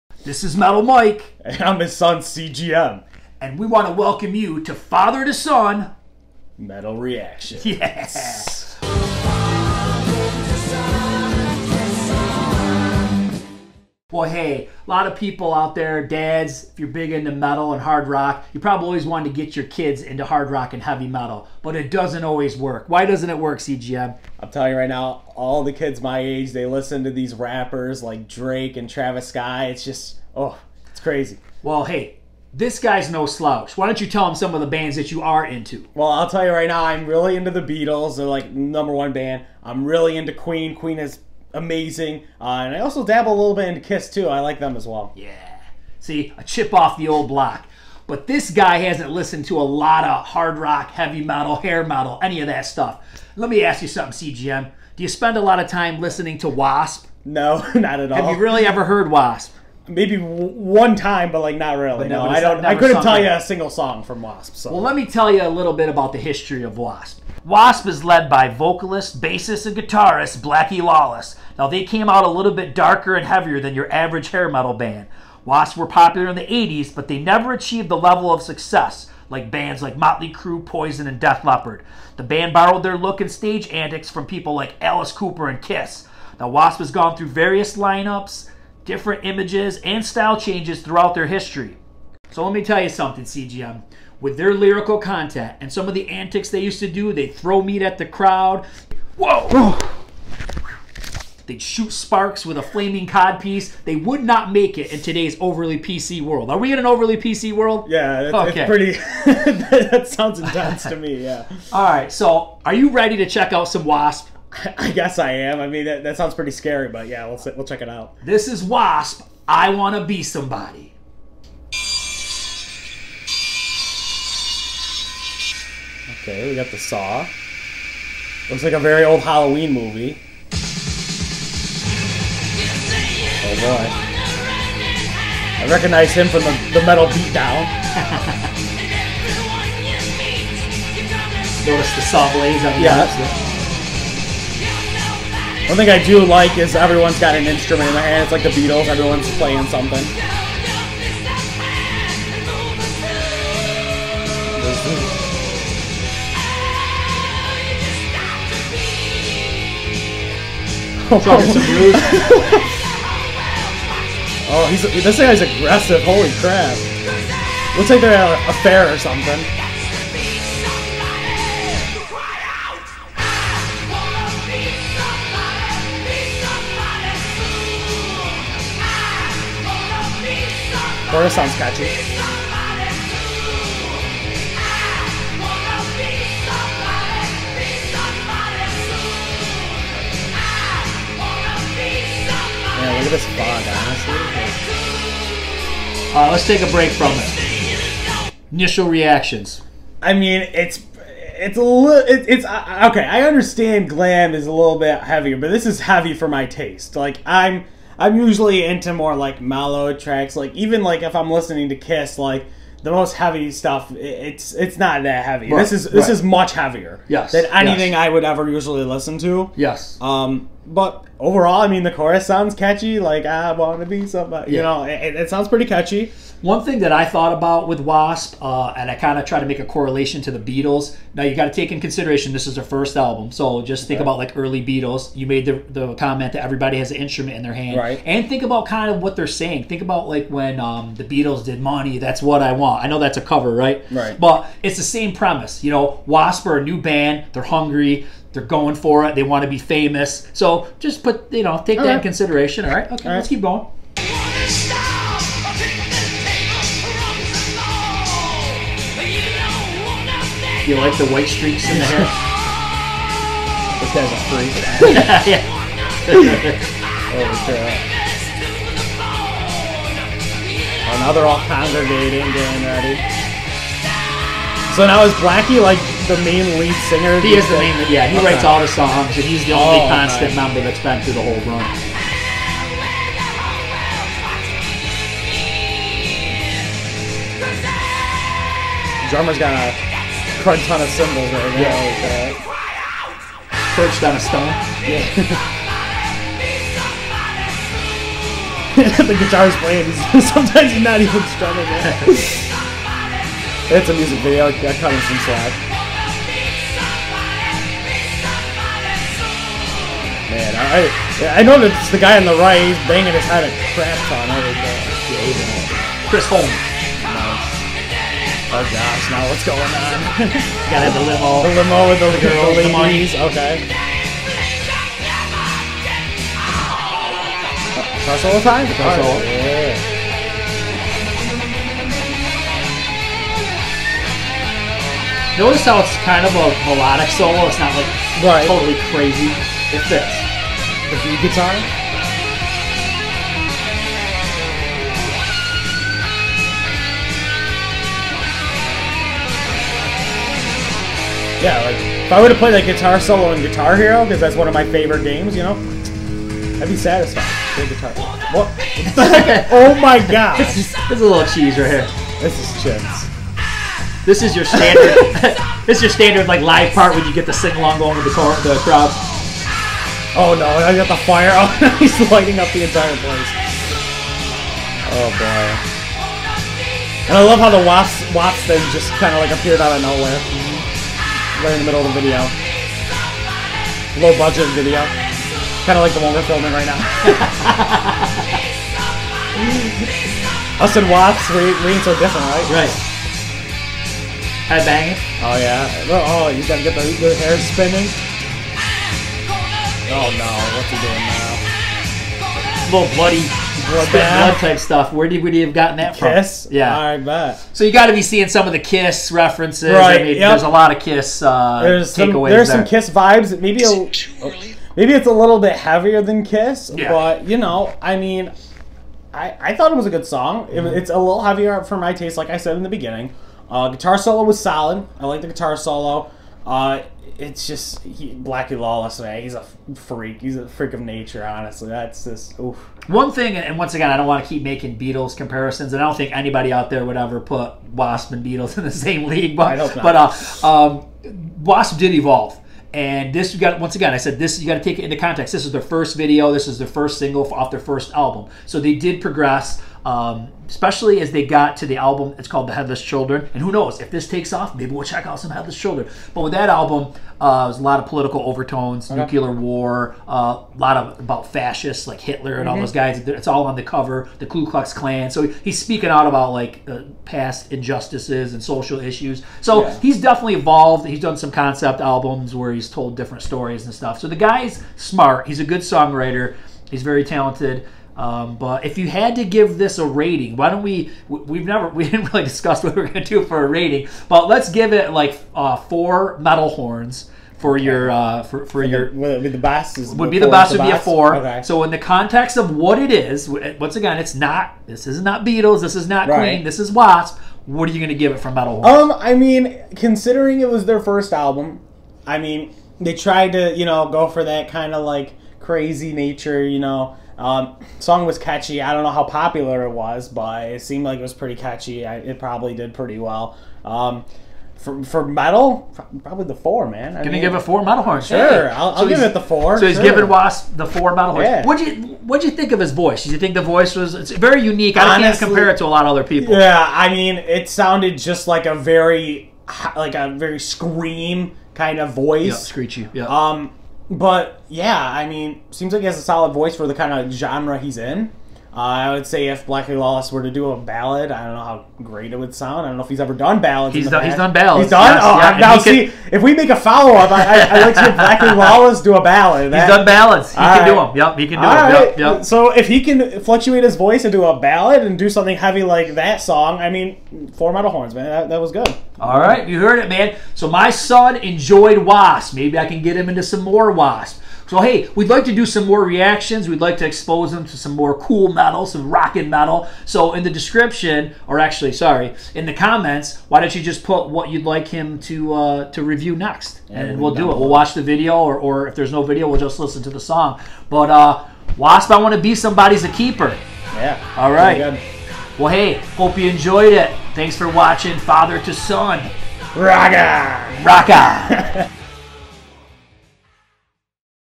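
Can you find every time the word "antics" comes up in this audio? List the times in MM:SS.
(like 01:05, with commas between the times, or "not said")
01:23, 01:36.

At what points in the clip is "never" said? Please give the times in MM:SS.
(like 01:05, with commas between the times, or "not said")
01:17, 08:01.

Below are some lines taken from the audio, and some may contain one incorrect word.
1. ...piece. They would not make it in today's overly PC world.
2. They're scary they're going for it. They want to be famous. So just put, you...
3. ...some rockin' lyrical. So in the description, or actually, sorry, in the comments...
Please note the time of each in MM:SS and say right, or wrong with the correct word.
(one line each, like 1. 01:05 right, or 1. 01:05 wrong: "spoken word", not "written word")
1. 01:43 right
2. 04:07 wrong: "hungry", not "scary"
3. 09:28 wrong: "metal", not "lyrical".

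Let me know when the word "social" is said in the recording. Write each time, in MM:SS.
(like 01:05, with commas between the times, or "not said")
07:48.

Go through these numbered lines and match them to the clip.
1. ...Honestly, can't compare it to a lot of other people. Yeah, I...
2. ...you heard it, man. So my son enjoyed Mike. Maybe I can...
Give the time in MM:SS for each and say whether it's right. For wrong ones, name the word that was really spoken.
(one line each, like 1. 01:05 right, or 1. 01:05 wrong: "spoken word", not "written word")
1. 08:44 right
2. 09:19 wrong: "Wasp", not "Mike".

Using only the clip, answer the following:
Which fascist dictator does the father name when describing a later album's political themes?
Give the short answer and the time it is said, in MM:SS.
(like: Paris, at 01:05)
Hitler, at 07:41.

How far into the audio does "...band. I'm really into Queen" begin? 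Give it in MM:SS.
00:39.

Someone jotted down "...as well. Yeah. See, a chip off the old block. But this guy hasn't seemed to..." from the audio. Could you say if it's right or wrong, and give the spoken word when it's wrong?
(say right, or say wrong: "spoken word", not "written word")
wrong: "listened", not "seemed".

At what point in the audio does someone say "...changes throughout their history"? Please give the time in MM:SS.
01:30.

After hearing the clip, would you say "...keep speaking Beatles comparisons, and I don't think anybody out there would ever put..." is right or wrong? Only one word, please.
wrong.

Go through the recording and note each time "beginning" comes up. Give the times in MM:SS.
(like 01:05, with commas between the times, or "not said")
07:02.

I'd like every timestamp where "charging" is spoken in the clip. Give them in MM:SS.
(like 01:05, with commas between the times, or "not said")
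not said.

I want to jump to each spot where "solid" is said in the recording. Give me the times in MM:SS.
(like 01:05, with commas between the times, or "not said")
07:04, 08:56.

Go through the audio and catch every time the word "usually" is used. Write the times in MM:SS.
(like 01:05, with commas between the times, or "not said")
03:28, 03:38.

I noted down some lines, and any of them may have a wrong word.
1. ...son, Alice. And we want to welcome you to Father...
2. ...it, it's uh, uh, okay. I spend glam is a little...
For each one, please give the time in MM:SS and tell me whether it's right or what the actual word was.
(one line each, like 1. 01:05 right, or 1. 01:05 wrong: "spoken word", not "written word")
1. 00:01 wrong: "CGM", not "Alice"
2. 03:22 wrong: "understand", not "spend".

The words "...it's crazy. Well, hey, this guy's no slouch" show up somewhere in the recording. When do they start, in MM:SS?
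00:30.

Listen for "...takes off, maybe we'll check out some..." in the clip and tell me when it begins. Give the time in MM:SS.
07:34.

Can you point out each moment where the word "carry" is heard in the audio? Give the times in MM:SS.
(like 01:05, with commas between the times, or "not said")
not said.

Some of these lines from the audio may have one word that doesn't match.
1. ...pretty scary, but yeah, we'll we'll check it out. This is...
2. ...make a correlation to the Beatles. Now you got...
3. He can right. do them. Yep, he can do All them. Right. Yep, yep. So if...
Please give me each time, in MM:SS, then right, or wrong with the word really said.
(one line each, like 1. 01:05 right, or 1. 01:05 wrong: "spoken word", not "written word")
1. 01:56 right
2. 03:49 right
3. 09:10 right.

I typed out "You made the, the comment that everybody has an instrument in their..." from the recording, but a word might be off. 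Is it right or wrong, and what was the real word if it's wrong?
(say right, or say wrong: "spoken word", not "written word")
right.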